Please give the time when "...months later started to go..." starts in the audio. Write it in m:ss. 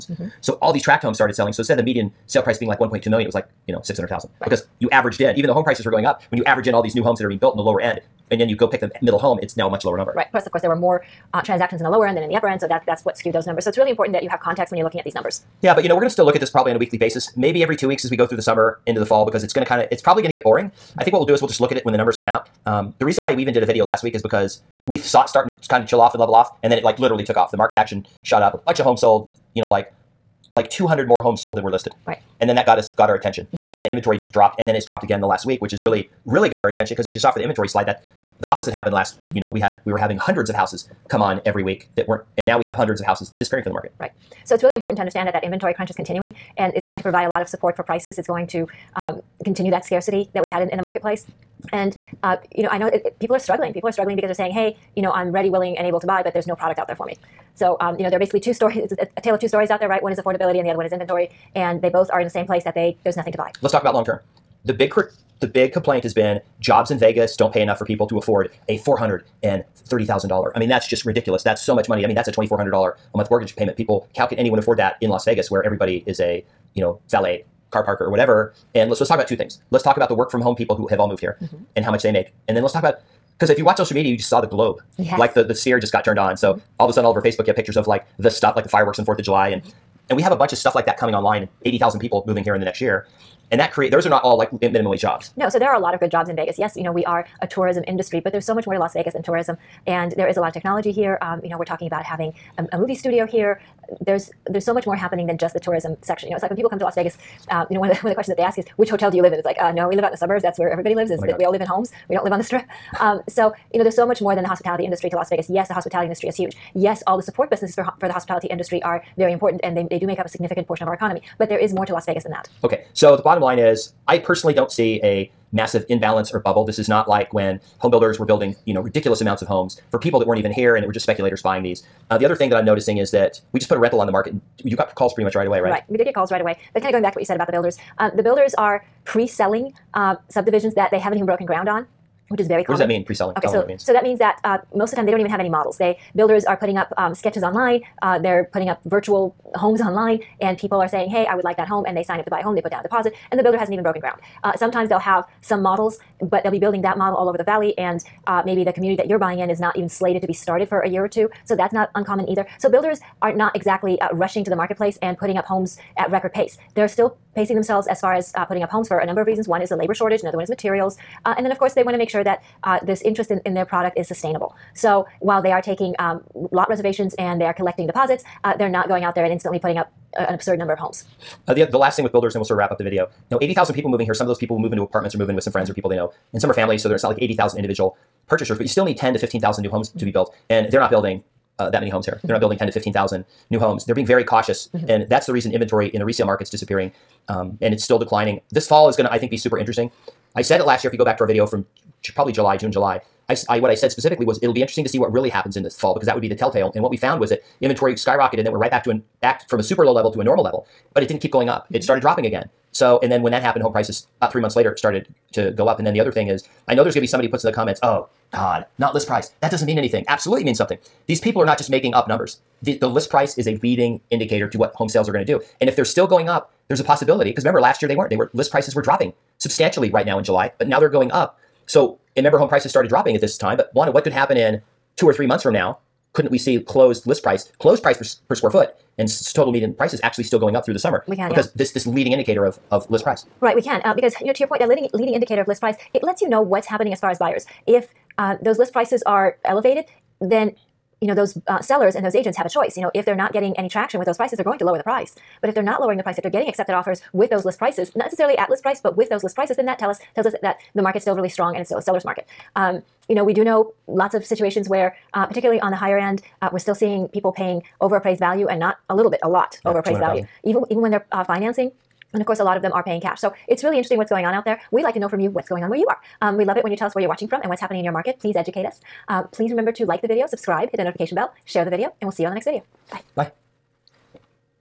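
3:34.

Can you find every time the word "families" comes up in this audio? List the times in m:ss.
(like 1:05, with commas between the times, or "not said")
3:06.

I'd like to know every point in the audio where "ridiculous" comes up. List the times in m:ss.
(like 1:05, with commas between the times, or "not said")
1:11, 2:08.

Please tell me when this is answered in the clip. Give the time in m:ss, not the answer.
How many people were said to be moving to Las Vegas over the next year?
1:31.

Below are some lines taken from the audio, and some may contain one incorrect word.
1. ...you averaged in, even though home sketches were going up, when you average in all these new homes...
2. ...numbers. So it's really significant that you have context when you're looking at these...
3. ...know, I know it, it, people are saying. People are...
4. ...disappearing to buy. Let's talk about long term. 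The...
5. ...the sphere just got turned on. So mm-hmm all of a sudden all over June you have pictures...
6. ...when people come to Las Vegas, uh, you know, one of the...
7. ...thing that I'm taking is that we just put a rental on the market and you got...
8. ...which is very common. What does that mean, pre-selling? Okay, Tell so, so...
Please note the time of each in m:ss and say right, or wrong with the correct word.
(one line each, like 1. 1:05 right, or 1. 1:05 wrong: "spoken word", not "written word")
1. 0:04 wrong: "prices", not "sketches"
2. 0:13 wrong: "important", not "significant"
3. 0:52 wrong: "struggling", not "saying"
4. 1:03 wrong: "nothing", not "disappearing"
5. 1:25 wrong: "Facebook", not "June"
6. 1:46 right
7. 2:12 wrong: "noticing", not "taking"
8. 2:22 right.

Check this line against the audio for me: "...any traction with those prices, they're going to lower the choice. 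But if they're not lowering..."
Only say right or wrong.
wrong.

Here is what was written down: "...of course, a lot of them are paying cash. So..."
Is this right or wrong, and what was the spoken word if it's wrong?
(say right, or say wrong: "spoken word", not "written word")
right.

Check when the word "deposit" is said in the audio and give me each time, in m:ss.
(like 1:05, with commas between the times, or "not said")
2:32, 2:57.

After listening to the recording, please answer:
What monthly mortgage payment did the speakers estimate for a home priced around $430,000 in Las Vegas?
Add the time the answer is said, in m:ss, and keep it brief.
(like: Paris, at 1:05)
$2,400, at 1:12.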